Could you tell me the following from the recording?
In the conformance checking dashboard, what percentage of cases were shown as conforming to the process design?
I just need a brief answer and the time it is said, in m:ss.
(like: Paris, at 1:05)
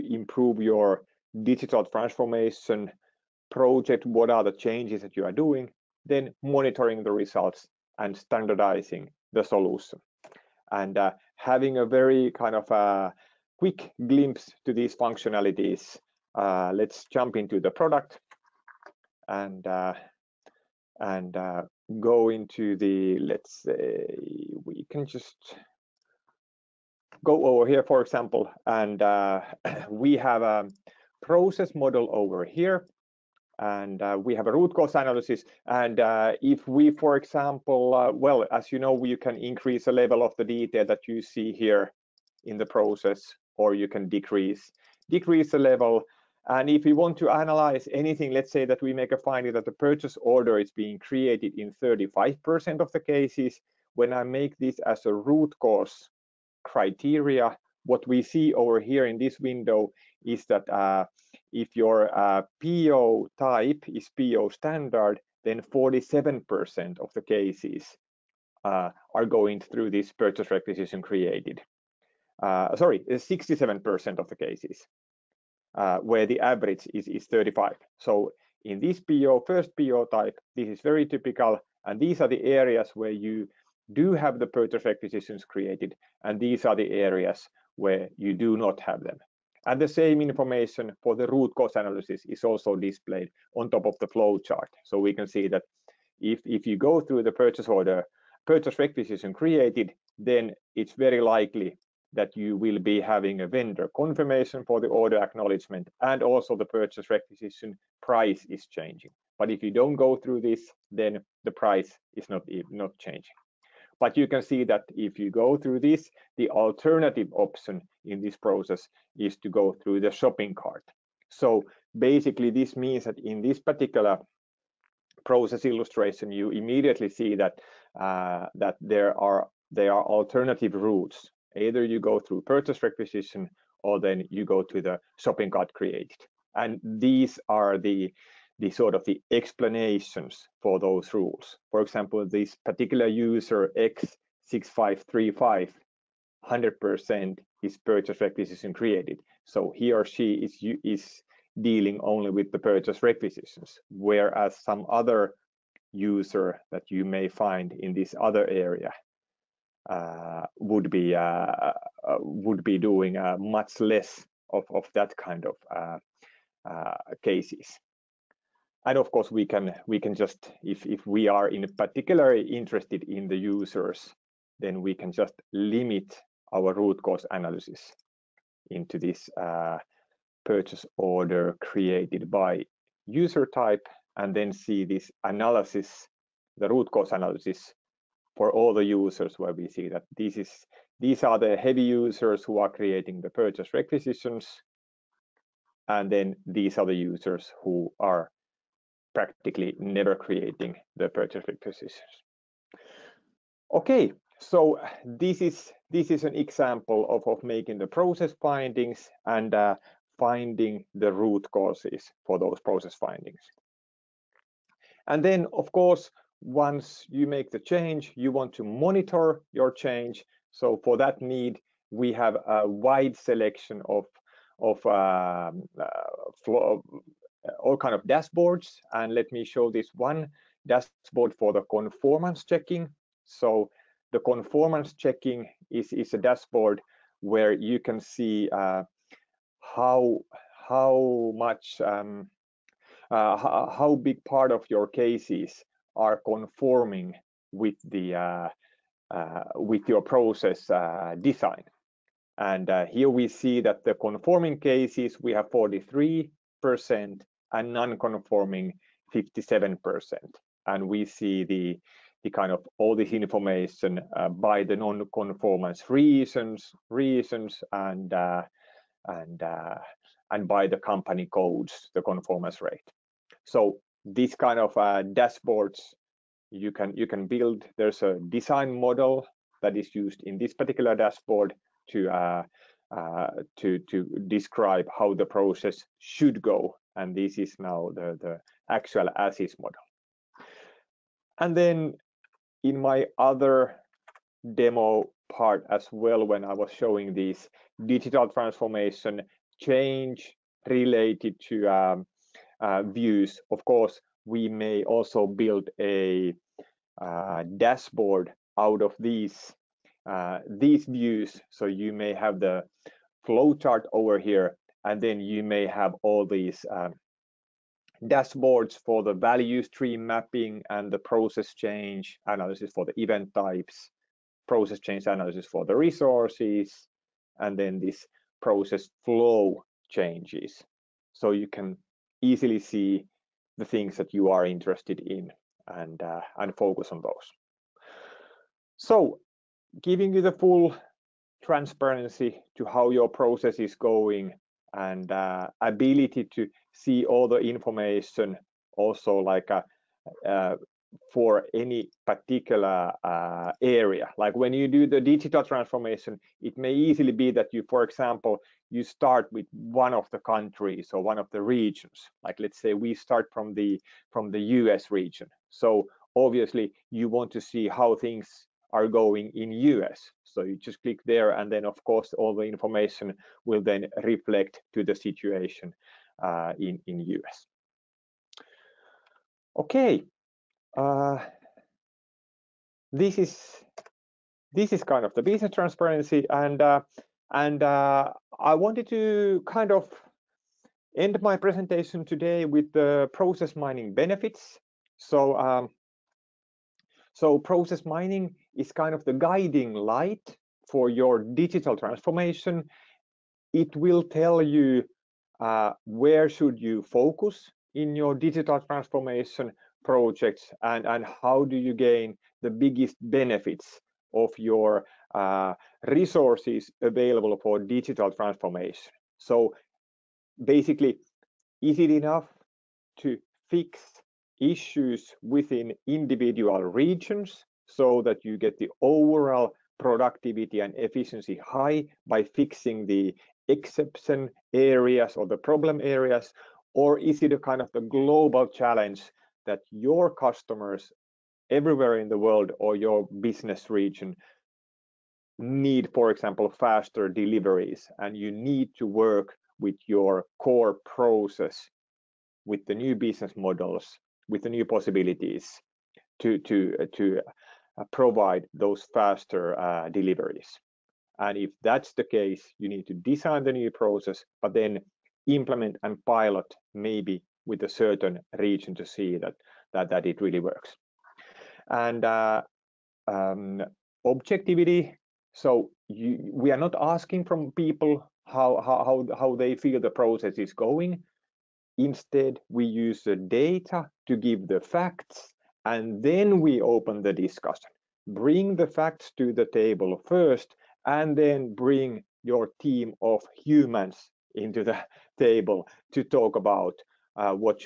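43%, at 4:15.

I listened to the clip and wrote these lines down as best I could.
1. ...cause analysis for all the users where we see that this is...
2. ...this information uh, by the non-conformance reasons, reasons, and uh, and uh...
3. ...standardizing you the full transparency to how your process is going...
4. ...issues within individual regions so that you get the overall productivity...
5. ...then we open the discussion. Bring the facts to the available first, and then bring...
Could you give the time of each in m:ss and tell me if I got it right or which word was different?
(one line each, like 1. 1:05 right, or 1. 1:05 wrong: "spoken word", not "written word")
1. 3:06 right
2. 4:22 right
3. 5:39 wrong: "giving", not "standardizing"
4. 7:04 right
5. 8:06 wrong: "table", not "available".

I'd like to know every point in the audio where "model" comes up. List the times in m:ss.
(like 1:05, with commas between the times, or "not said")
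0:31, 4:38, 4:49, 7:33.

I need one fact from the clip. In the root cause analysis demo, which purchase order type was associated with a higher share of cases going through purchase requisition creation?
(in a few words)
PO standard.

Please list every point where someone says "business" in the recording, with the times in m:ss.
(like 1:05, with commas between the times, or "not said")
6:25, 7:23, 7:32.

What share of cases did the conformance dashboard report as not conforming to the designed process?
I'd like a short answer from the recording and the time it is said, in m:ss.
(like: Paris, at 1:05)
57%, at 4:19.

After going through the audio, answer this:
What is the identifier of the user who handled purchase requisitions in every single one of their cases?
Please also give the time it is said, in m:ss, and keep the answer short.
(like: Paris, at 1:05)
X6535, at 2:24.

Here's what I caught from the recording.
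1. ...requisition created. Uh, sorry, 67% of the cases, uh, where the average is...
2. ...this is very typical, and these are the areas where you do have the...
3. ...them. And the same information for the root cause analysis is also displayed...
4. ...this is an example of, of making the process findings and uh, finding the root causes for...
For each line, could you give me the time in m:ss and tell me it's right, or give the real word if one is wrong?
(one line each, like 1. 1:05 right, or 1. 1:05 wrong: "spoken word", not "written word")
1. 1:10 right
2. 1:20 right
3. 1:29 right
4. 3:25 right.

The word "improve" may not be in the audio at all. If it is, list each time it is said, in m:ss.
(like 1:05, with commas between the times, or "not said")
0:00.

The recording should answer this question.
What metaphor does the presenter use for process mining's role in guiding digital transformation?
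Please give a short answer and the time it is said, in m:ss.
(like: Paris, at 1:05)
The guiding light, at 6:39.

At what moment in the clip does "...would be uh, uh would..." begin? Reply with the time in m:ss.
2:40.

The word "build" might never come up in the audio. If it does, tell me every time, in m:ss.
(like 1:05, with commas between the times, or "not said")
4:37, 5:05.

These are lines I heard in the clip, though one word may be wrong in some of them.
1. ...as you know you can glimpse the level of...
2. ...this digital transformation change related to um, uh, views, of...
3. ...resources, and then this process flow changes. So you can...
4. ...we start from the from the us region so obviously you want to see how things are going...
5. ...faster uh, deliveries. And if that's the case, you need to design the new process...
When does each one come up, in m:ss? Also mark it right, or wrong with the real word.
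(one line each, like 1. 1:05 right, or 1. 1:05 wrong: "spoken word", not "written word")
1. 0:38 wrong: "increase", not "glimpse"
2. 4:57 right
3. 5:25 right
4. 6:02 right
5. 7:38 right.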